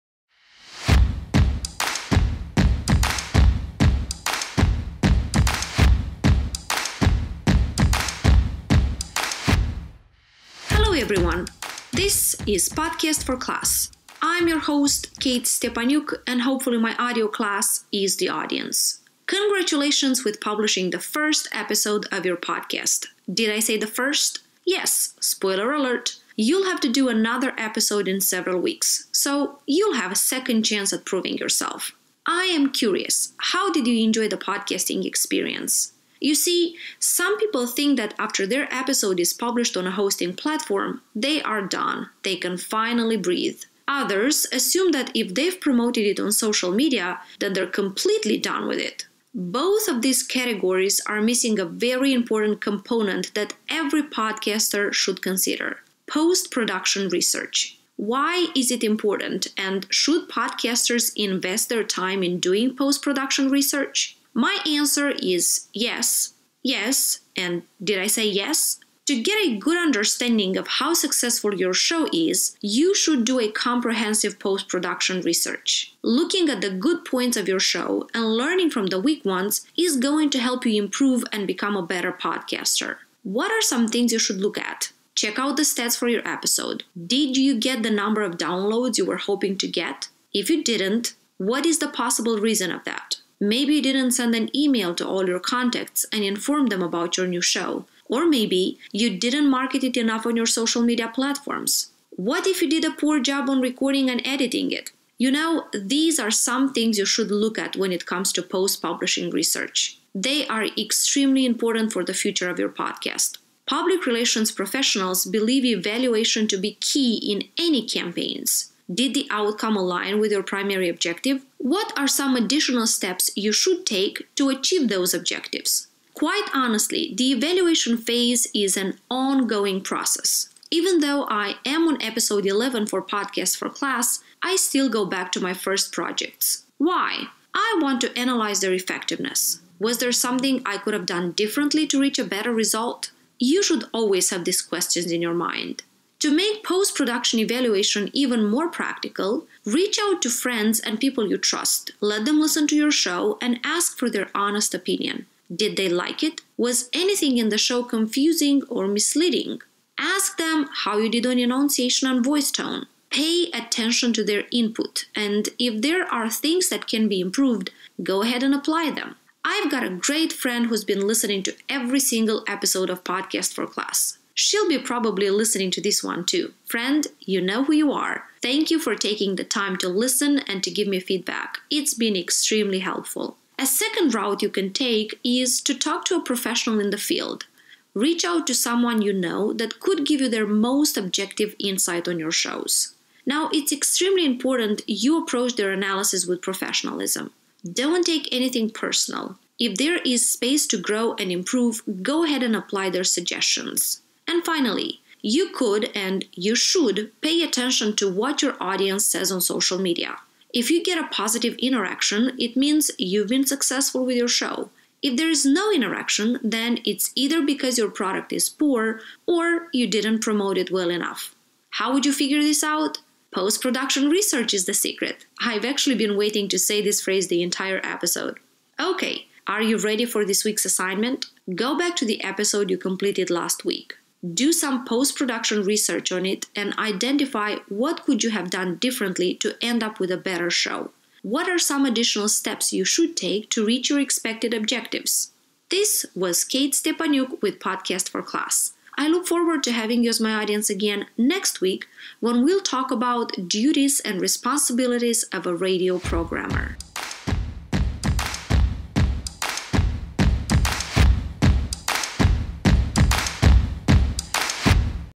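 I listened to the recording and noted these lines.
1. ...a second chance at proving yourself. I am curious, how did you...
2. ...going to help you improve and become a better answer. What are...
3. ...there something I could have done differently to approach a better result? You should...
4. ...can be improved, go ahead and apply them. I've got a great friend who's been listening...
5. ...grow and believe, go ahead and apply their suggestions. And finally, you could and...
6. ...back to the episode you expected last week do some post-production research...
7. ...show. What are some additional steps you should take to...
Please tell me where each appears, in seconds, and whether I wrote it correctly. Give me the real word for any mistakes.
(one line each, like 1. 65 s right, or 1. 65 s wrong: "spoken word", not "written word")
1. 30 s right
2. 79 s wrong: "podcaster", not "answer"
3. 139 s wrong: "reach", not "approach"
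4. 166 s right
5. 200 s wrong: "improve", not "believe"
6. 231 s wrong: "completed", not "expected"
7. 240 s right.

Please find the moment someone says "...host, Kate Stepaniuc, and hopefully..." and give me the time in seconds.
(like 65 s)
14 s.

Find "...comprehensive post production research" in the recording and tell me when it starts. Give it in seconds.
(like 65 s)
73 s.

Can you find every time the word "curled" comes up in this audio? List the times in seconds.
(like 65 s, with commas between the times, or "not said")
not said.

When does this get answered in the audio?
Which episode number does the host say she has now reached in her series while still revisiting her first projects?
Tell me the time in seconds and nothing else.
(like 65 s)
132 s.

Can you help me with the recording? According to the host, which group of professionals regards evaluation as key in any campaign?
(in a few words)
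Public relations professionals.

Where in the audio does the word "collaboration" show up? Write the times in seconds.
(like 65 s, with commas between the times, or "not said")
not said.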